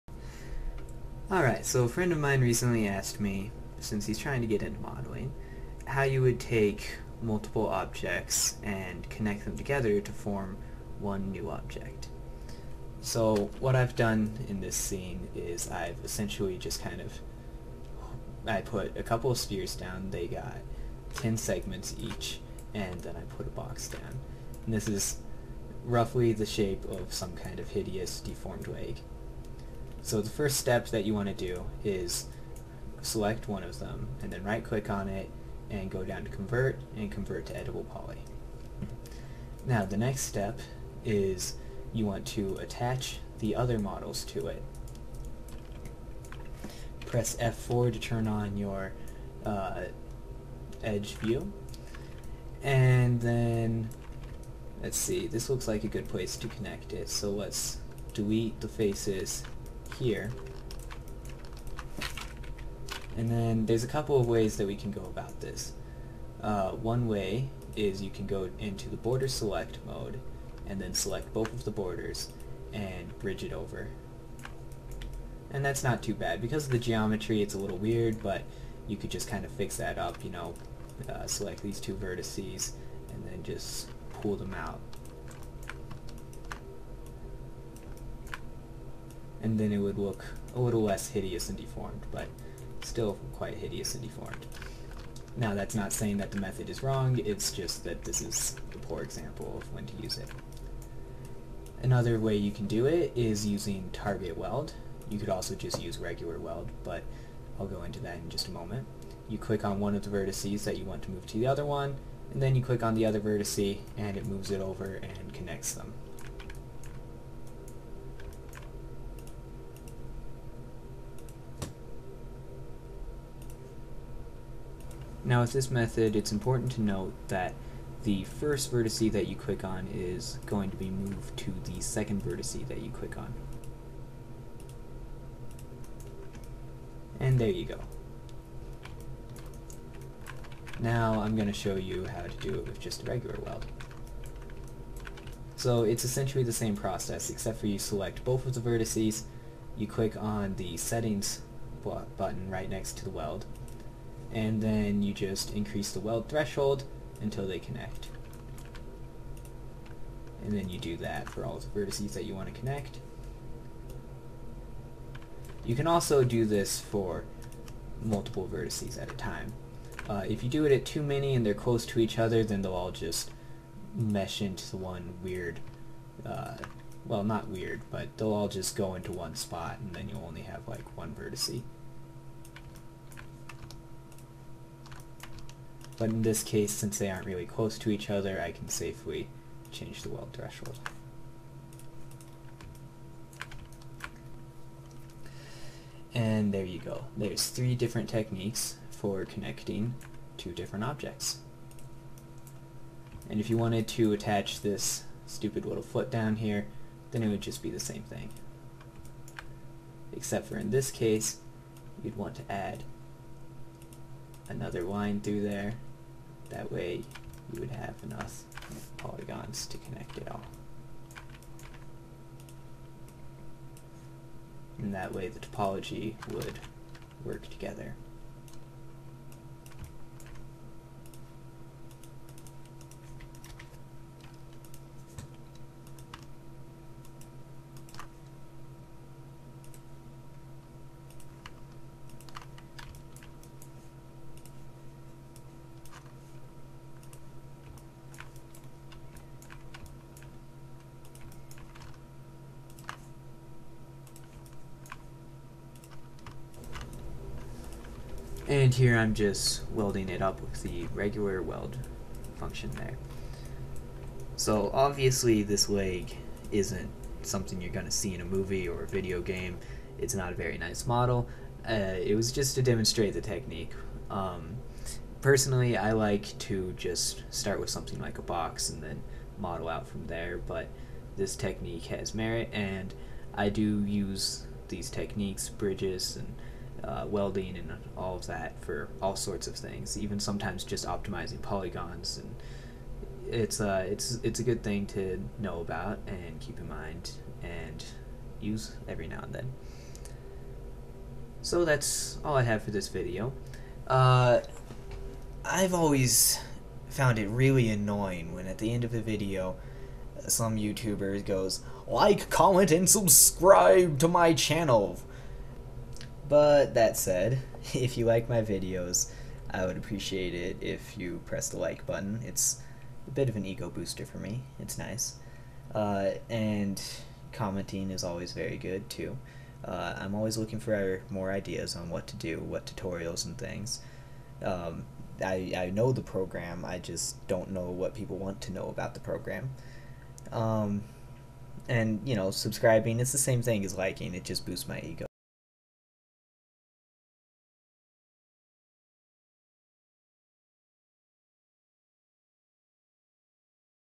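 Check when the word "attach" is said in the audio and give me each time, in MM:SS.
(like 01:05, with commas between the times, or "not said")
00:42, 03:24.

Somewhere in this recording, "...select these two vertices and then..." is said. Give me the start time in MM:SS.
01:21.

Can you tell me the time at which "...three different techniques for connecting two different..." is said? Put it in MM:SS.
03:17.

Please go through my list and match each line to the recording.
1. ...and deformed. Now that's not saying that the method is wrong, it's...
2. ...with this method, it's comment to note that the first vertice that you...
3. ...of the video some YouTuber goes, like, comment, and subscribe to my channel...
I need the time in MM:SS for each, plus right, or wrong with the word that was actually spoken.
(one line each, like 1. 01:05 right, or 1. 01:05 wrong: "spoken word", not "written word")
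1. 01:33 right
2. 02:05 wrong: "important", not "comment"
3. 05:08 right.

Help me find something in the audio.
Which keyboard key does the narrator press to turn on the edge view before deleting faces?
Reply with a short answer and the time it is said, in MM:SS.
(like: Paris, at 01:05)
F4, at 00:47.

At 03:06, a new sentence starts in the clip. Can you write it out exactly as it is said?
But in this case, since they aren't really close to each other, I can safely change the weld threshold.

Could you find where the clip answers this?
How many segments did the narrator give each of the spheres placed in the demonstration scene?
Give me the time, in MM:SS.
00:21.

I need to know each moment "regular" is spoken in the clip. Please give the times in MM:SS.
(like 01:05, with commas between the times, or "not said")
01:45, 02:23, 04:20.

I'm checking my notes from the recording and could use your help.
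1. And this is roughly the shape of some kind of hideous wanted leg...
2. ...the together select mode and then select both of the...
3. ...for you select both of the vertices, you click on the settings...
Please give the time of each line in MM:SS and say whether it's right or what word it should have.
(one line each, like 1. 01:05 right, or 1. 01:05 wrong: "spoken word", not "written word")
1. 00:24 wrong: "deformed", not "wanted"
2. 01:08 wrong: "border", not "together"
3. 02:27 right.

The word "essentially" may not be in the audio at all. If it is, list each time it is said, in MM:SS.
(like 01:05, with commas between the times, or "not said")
00:16, 02:26.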